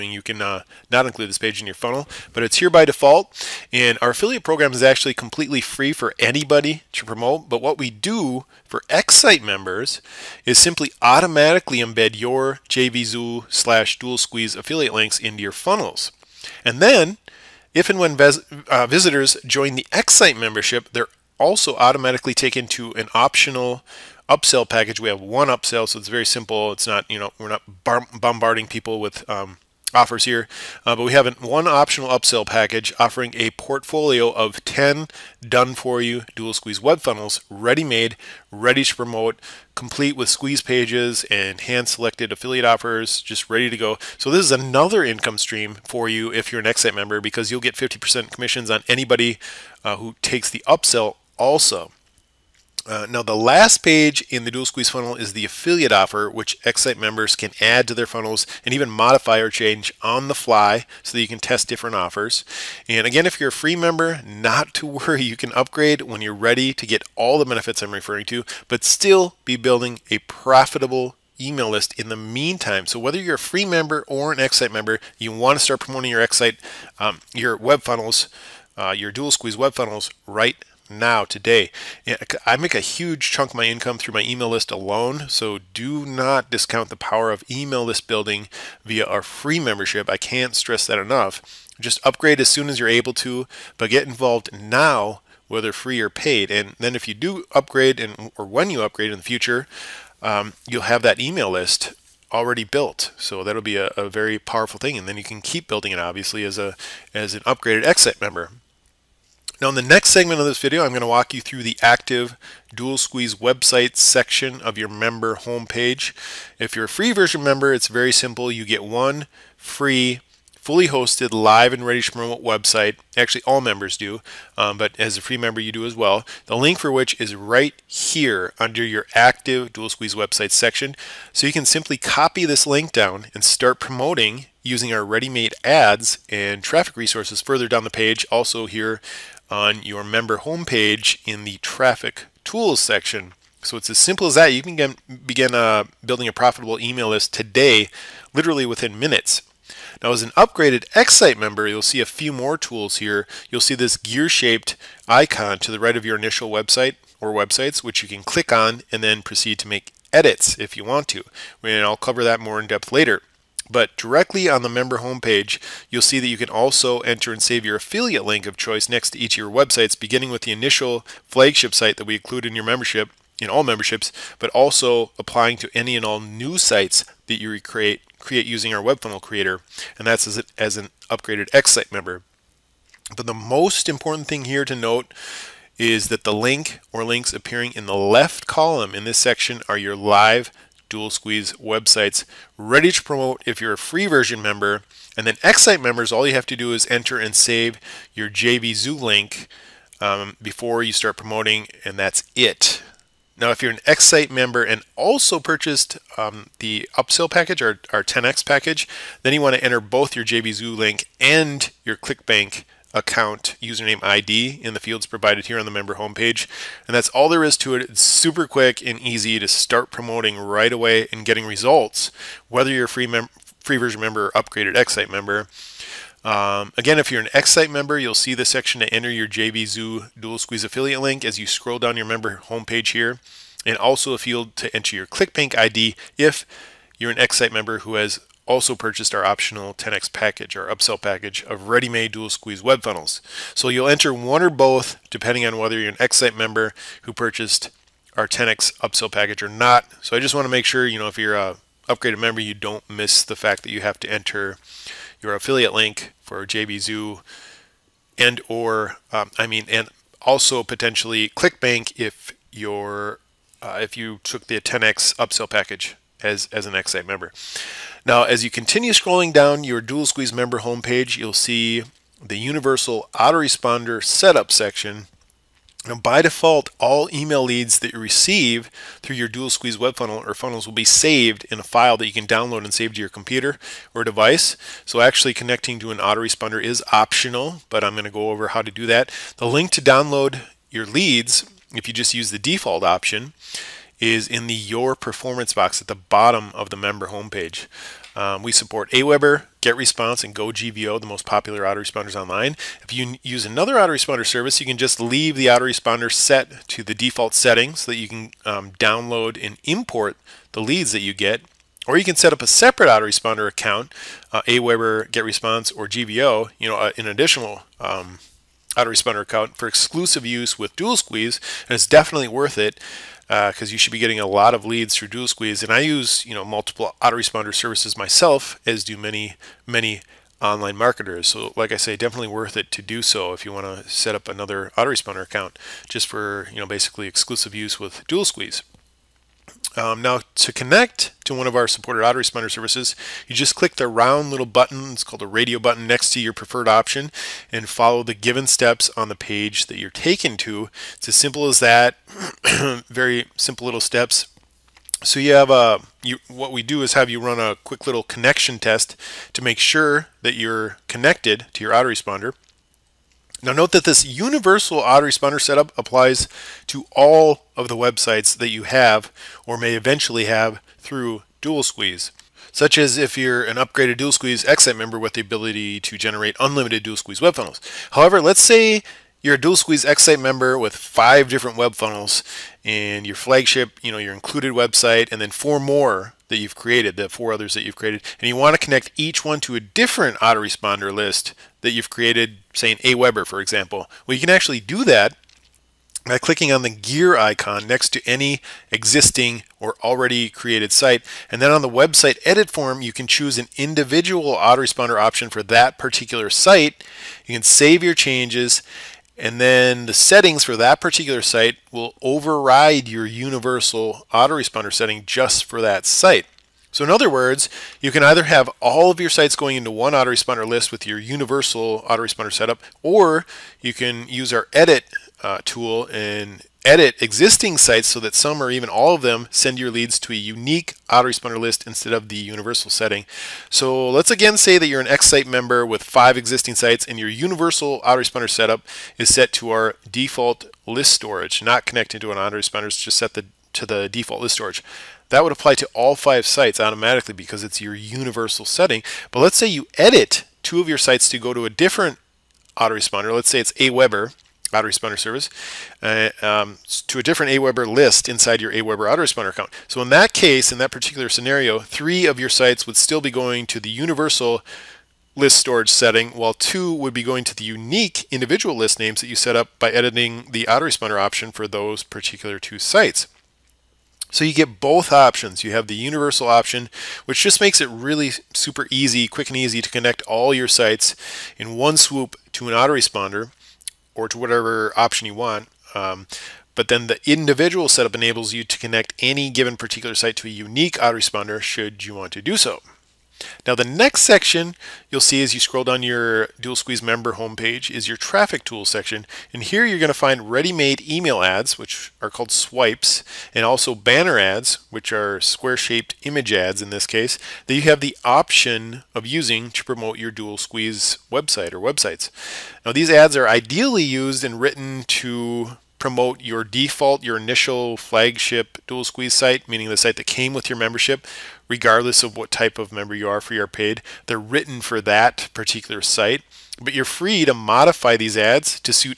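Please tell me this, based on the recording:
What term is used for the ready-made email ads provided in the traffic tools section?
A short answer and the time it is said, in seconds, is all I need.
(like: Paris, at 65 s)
swipes, at 502 s.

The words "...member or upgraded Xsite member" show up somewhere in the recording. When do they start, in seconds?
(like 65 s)
223 s.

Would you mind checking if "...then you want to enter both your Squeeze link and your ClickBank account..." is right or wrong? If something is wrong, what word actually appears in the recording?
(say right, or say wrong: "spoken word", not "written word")
wrong: "JVZoo", not "Squeeze".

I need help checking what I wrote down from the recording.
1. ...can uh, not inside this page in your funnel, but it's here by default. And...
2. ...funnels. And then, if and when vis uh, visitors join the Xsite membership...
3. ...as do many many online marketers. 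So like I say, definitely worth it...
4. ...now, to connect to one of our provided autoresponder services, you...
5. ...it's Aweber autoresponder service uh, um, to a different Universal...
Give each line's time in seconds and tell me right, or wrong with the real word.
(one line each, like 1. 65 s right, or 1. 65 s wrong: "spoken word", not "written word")
1. 0 s wrong: "include", not "inside"
2. 15 s right
3. 328 s right
4. 340 s wrong: "supported", not "provided"
5. 453 s wrong: "Aweber", not "Universal".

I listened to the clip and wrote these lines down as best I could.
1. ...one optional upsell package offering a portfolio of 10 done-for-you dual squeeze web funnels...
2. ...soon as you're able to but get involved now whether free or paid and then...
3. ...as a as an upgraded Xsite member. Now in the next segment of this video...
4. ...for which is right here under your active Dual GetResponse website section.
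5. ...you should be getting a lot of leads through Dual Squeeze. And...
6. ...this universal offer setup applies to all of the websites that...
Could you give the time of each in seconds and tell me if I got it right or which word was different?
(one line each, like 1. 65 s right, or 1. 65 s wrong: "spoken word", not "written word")
1. 31 s right
2. 92 s right
3. 106 s right
4. 126 s wrong: "Squeeze", not "GetResponse"
5. 323 s right
6. 363 s wrong: "autoresponder", not "offer".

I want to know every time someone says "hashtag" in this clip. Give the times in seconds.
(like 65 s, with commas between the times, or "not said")
not said.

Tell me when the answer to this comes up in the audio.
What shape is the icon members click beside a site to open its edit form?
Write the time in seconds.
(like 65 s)
396 s.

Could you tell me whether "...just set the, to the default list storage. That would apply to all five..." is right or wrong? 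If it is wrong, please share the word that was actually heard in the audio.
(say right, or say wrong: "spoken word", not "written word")
right.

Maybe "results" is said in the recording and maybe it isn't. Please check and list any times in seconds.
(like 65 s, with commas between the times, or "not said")
221 s.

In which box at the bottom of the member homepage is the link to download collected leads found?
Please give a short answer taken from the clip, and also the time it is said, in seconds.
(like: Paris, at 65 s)
Your Performance, at 294 s.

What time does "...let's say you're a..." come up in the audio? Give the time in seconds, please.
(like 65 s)
378 s.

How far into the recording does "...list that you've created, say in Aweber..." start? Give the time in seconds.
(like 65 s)
390 s.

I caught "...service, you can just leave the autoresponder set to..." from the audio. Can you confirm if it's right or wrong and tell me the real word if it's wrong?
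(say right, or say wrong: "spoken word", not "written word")
right.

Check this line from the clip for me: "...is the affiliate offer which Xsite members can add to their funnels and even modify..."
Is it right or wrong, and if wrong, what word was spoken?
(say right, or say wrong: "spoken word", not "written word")
right.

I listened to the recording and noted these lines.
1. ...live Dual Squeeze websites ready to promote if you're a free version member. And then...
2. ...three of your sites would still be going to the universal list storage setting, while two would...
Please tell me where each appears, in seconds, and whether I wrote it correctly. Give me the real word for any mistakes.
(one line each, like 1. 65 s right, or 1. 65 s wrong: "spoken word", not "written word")
1. 189 s right
2. 461 s right.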